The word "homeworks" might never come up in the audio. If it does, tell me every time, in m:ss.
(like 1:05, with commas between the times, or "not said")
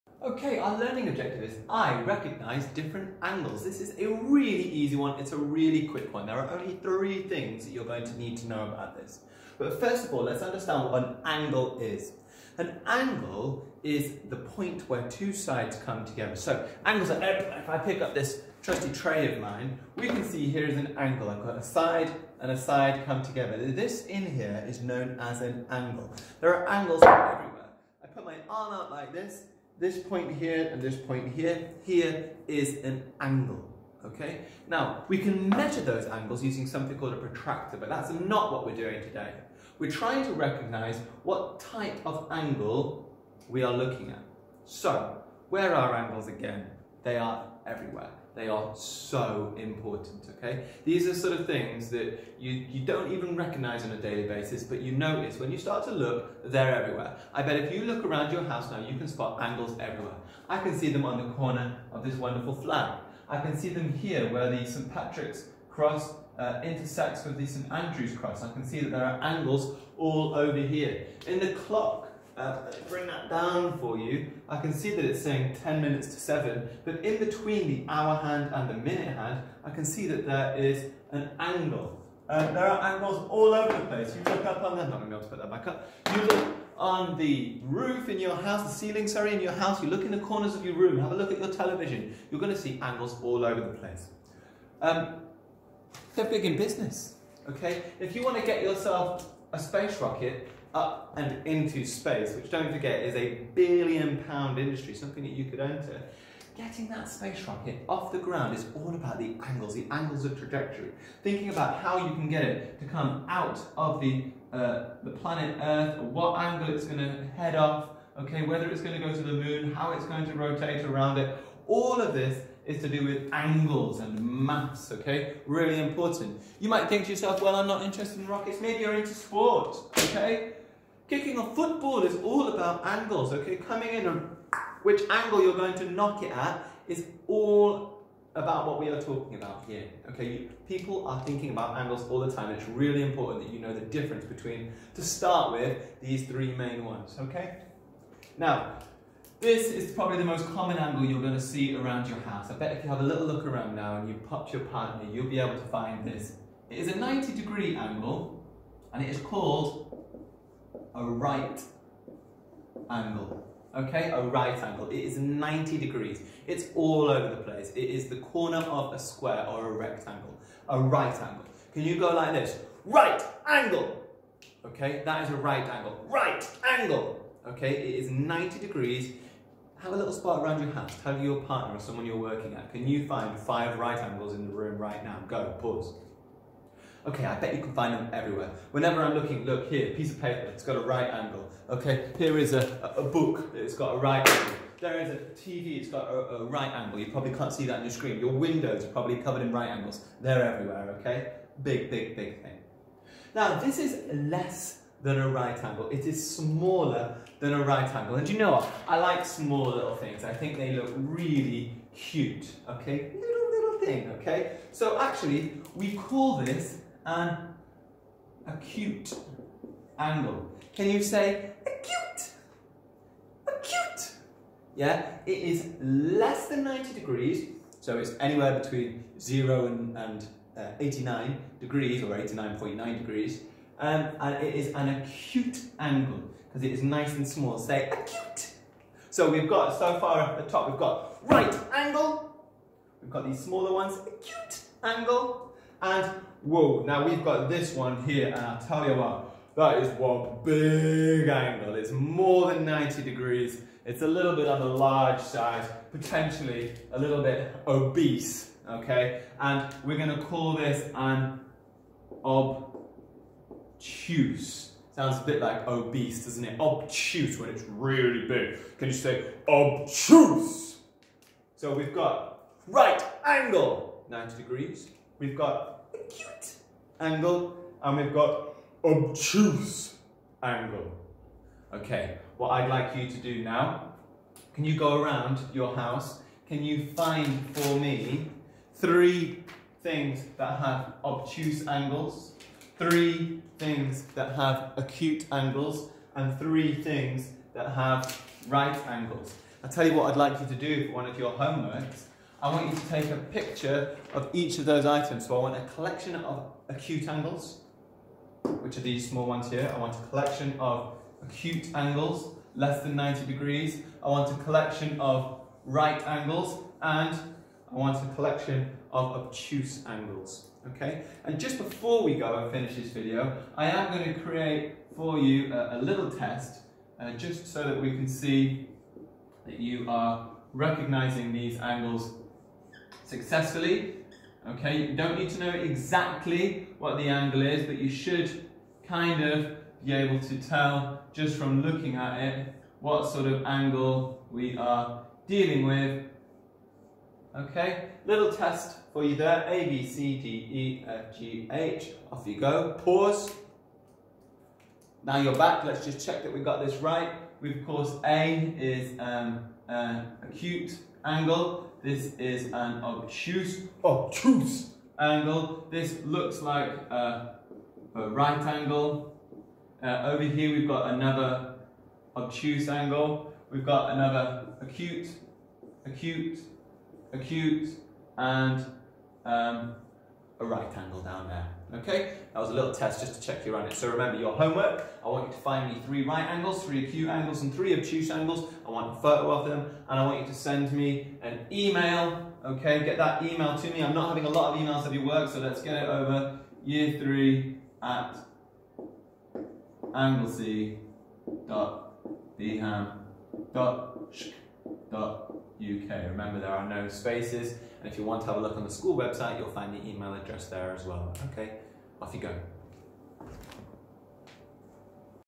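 5:01, 6:24.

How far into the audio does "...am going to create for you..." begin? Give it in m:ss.
5:23.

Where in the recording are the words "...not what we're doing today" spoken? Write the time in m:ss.
0:38.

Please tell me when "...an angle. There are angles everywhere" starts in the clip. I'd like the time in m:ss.
0:25.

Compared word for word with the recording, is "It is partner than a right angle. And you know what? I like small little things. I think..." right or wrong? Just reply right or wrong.
wrong.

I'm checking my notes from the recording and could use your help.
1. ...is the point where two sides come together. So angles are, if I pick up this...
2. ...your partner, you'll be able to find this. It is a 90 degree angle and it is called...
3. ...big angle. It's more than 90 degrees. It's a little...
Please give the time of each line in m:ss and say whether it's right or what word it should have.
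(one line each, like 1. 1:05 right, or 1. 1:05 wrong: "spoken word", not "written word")
1. 0:13 right
2. 2:34 right
3. 4:10 right.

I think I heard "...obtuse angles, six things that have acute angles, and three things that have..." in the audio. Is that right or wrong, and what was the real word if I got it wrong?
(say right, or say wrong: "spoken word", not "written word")
wrong: "three", not "six".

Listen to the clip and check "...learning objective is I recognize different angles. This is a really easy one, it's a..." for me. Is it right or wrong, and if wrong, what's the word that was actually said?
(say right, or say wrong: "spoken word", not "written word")
right.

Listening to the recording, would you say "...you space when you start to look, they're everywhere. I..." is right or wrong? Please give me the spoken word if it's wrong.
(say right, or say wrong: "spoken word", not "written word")
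wrong: "notice", not "space".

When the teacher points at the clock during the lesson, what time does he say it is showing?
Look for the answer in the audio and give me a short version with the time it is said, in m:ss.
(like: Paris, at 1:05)
10 minutes to 7, at 1:15.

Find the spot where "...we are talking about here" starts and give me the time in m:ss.
2:18.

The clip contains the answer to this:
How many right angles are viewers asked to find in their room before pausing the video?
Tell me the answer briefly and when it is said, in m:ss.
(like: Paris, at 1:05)
5, at 3:03.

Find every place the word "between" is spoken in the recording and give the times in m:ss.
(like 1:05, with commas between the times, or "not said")
1:17, 2:24, 3:48.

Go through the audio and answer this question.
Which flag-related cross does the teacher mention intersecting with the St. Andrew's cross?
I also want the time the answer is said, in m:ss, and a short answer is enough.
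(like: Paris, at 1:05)
St. Patrick's cross, at 1:04.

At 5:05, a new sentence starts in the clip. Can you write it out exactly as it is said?
So I want a collection of acute angles, which are these small ones here.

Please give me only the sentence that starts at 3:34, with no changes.
So actually, we call this an acute angle.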